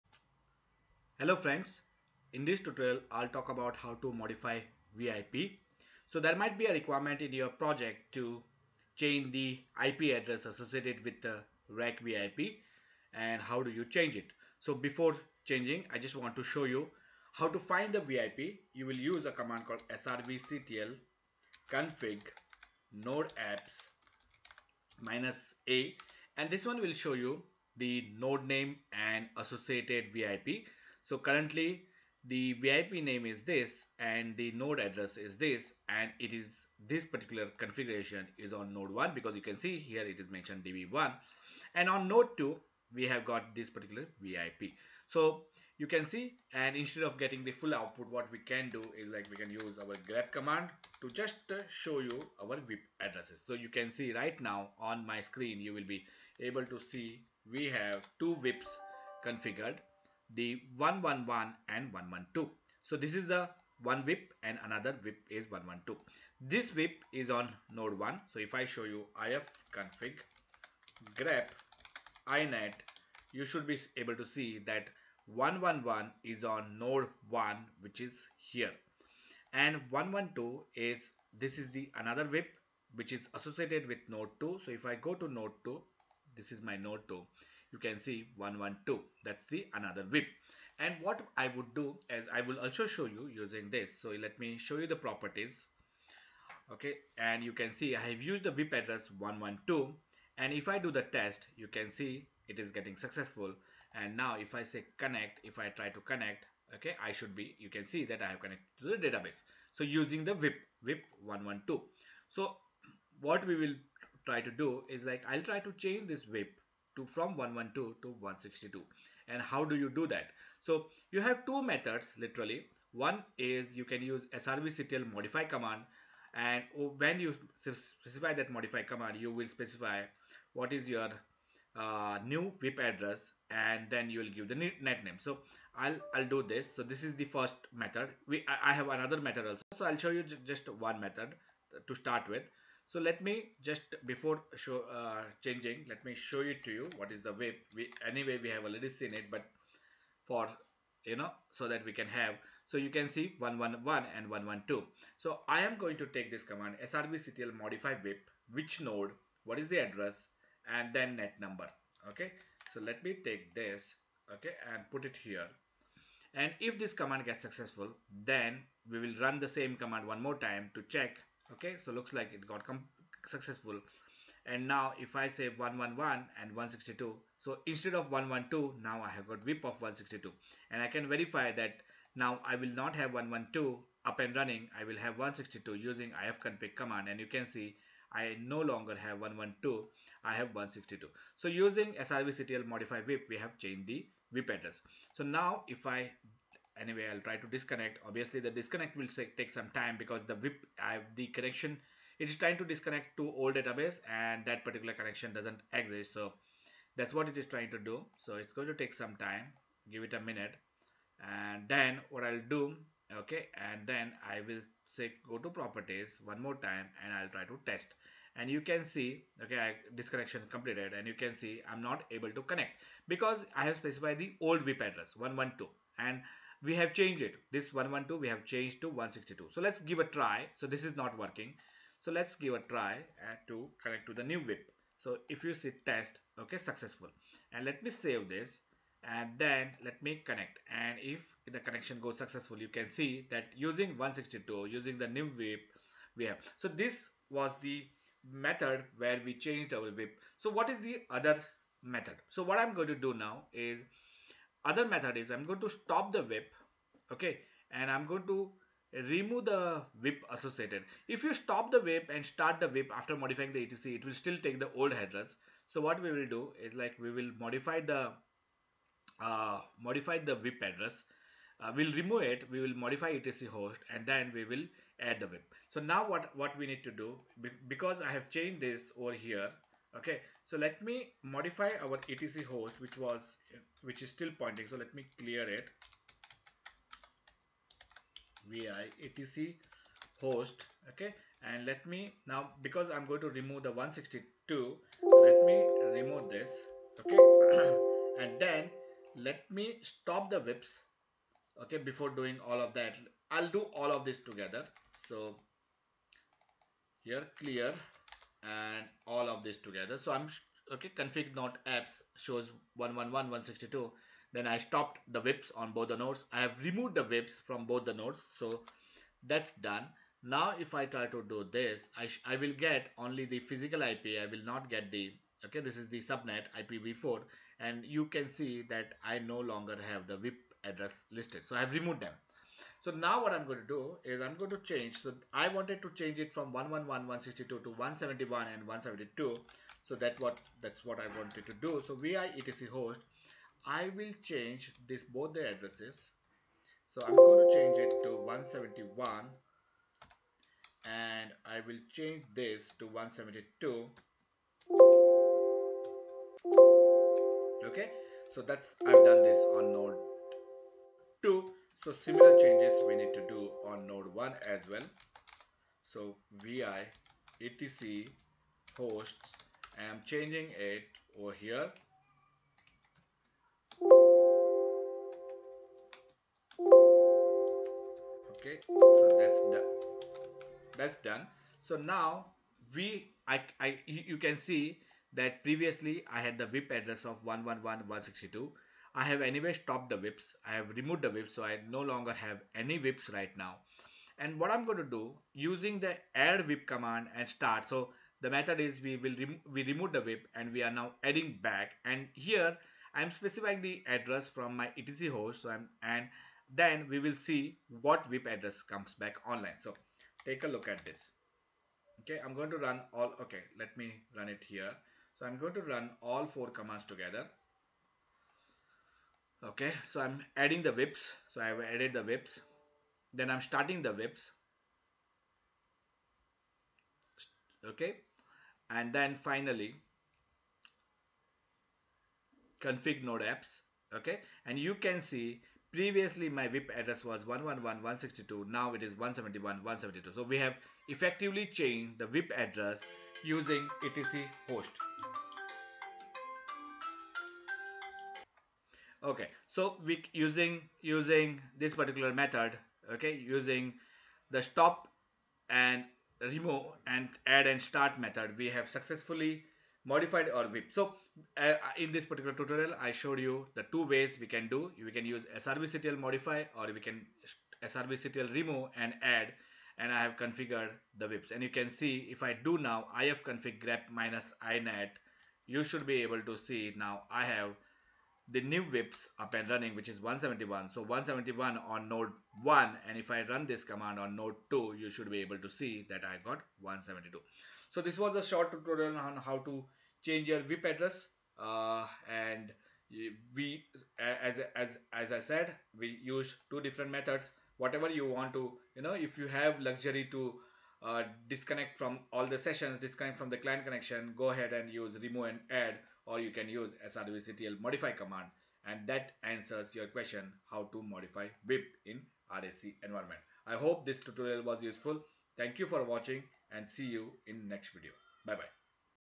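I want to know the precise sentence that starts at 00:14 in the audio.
So before changing I just want to show you how to find the VIP.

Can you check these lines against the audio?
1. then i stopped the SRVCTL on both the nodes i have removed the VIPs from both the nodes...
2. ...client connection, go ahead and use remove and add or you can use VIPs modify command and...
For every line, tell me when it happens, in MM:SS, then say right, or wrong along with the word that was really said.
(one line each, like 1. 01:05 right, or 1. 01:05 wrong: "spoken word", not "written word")
1. 05:14 wrong: "VIPs", not "SRVCTL"
2. 08:23 wrong: "SRVCTL", not "VIPs".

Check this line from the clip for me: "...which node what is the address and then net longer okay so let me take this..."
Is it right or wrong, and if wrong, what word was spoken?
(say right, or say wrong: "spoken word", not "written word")
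wrong: "number", not "longer".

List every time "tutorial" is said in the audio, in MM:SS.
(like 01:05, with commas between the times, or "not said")
00:02, 07:42, 08:08, 08:33.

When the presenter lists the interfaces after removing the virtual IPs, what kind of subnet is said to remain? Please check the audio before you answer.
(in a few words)
IPv4.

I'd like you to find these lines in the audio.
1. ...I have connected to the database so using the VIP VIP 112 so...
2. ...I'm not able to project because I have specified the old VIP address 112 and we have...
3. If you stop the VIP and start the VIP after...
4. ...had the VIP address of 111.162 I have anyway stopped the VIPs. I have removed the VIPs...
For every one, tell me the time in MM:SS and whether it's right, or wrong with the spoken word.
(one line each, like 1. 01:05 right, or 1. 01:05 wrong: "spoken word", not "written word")
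1. 01:48 right
2. 03:41 wrong: "connect", not "project"
3. 04:21 right
4. 06:26 right.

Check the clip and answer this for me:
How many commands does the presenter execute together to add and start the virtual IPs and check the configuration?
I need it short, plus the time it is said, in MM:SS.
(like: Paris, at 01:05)
4, at 06:56.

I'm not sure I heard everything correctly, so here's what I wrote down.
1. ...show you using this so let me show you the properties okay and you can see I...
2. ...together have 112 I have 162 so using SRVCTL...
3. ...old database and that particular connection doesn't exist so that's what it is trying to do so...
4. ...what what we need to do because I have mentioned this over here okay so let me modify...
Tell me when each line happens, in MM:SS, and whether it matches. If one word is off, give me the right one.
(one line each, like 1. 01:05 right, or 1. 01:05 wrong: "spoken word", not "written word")
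1. 01:32 right
2. 03:08 wrong: "longer", not "together"
3. 03:23 right
4. 04:36 wrong: "changed", not "mentioned".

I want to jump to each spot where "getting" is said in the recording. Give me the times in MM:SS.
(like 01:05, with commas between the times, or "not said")
00:47, 01:42.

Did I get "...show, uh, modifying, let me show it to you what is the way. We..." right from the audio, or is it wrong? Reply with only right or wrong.
wrong.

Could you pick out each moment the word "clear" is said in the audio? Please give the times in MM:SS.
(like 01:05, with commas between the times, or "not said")
04:45, 05:07.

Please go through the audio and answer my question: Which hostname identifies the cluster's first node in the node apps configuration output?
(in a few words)
DB1.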